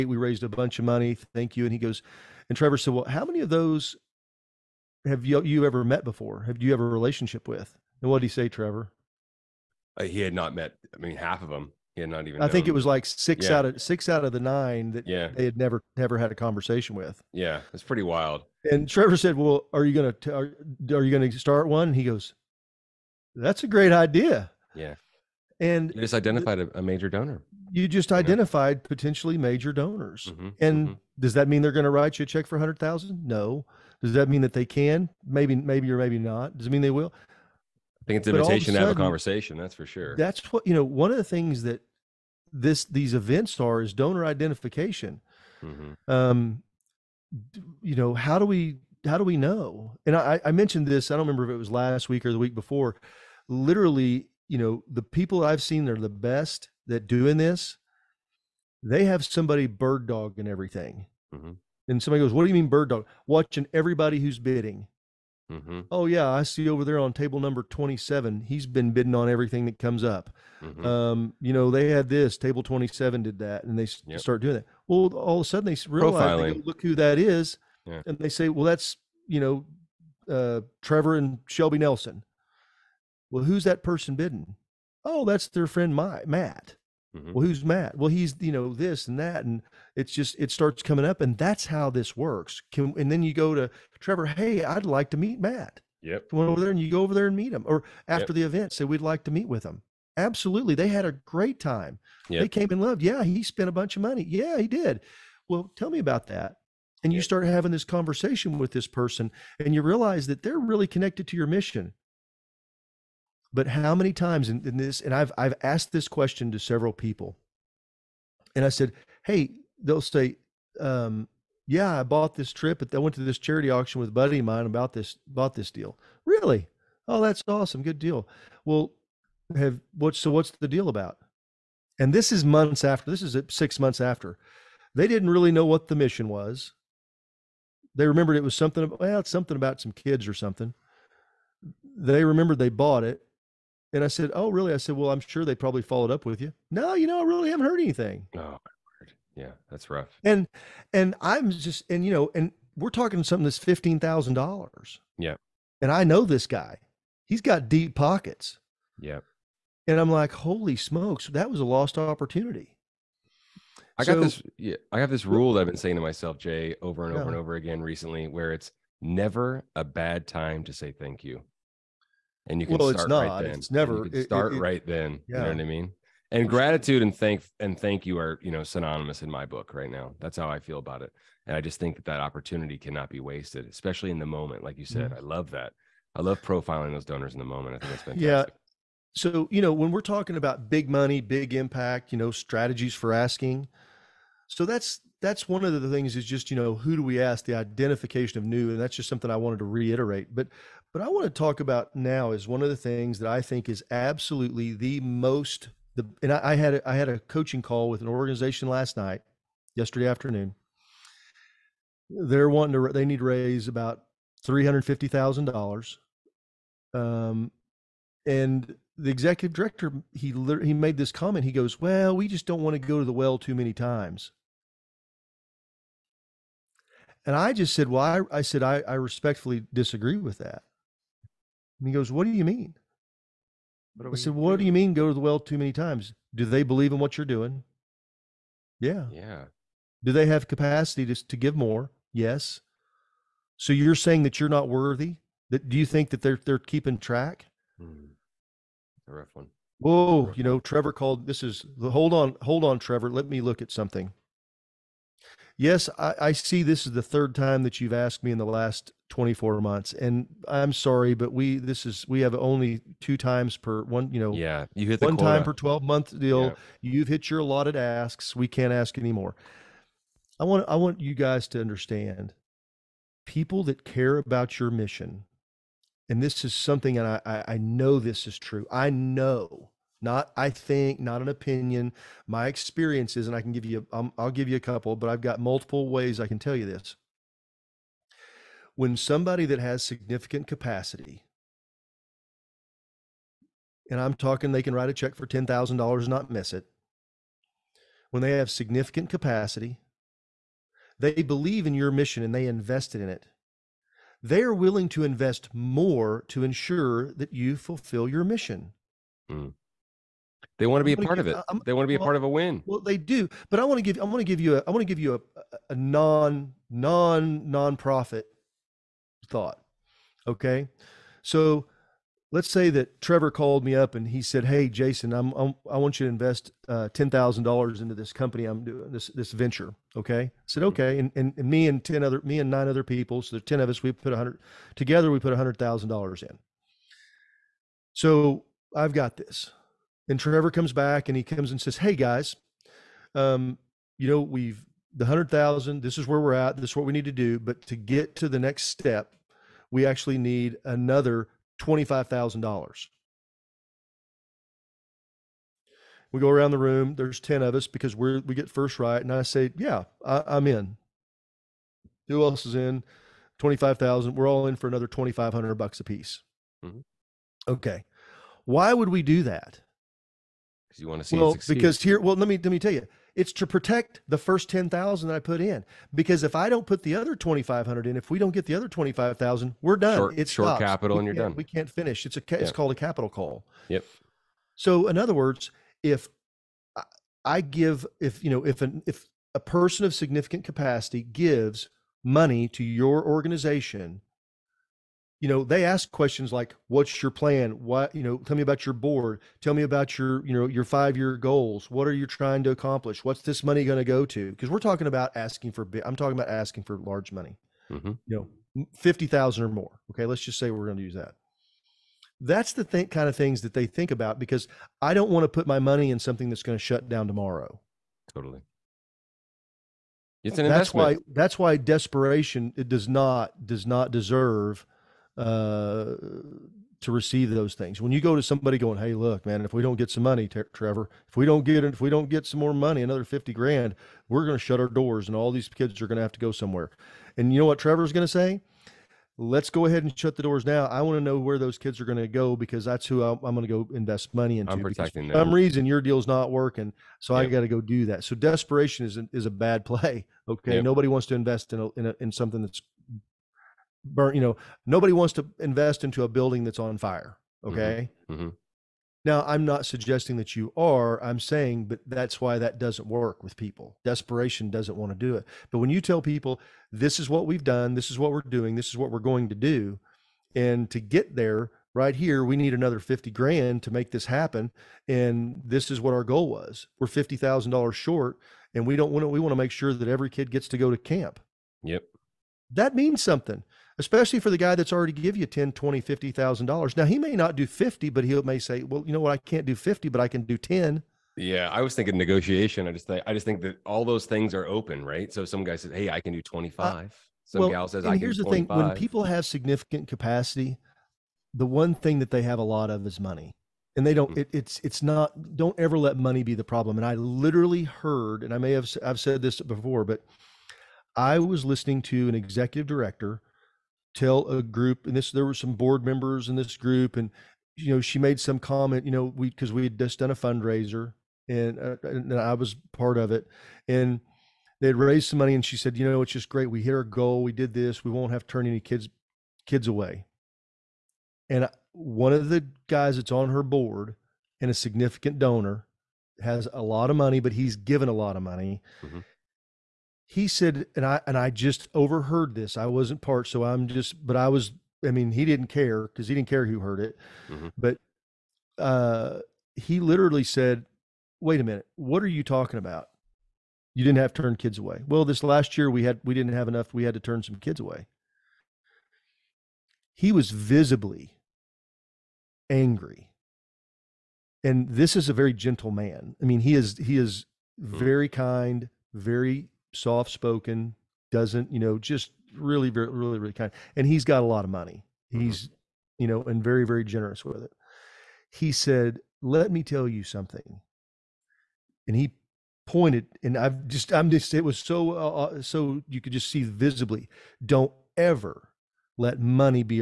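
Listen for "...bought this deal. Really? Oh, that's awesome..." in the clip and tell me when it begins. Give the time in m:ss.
2:05.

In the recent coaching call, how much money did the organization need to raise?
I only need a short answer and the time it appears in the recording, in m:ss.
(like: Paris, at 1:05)
$350,000, at 3:34.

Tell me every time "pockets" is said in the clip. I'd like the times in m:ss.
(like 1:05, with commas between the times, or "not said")
2:37.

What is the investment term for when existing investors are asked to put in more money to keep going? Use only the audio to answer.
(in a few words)
Capital call.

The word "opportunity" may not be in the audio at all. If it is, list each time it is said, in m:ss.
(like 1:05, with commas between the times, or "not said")
2:41, 3:02.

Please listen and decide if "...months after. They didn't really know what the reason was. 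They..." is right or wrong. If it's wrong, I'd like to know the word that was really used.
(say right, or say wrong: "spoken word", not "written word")
wrong: "mission", not "reason".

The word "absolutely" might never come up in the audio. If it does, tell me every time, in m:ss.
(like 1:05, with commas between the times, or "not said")
1:40, 3:23.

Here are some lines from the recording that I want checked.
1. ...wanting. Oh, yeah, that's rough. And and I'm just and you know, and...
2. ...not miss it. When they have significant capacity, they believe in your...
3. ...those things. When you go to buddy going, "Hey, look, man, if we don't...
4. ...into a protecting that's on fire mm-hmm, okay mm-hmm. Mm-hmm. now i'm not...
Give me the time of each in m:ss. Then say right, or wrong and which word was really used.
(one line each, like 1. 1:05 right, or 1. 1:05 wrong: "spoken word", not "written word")
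1. 2:27 wrong: "anything", not "wanting"
2. 4:56 right
3. 7:07 wrong: "somebody", not "buddy"
4. 7:35 wrong: "building", not "protecting".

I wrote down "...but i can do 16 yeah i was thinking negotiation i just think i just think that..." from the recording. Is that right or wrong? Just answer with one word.
wrong.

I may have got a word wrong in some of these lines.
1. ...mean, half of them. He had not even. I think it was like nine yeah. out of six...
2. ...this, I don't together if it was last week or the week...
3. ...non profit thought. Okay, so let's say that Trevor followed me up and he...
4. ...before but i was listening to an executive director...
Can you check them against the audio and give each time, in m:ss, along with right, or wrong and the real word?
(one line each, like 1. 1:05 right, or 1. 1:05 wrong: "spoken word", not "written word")
1. 0:10 wrong: "six", not "nine"
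2. 0:50 wrong: "remember", not "together"
3. 5:16 wrong: "called", not "followed"
4. 8:29 right.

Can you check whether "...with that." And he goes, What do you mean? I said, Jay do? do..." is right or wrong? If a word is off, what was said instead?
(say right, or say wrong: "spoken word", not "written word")
wrong: "What", not "Jay".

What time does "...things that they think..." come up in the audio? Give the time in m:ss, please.
6:53.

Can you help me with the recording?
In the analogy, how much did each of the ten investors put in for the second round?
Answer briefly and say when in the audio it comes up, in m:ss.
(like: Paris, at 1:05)
$2,500, at 6:04.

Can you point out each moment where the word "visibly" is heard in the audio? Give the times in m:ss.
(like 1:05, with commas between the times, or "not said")
9:20, 9:46.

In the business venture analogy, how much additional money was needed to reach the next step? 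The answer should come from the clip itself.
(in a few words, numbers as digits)
$25,000.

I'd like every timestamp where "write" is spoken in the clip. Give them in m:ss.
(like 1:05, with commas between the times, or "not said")
0:31, 4:54.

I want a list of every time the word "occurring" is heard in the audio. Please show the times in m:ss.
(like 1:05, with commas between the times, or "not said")
not said.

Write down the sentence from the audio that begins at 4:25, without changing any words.
time per 12 month deal yeah.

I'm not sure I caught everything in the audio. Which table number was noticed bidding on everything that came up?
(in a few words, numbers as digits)
27.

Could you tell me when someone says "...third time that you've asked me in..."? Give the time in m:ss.
4:17.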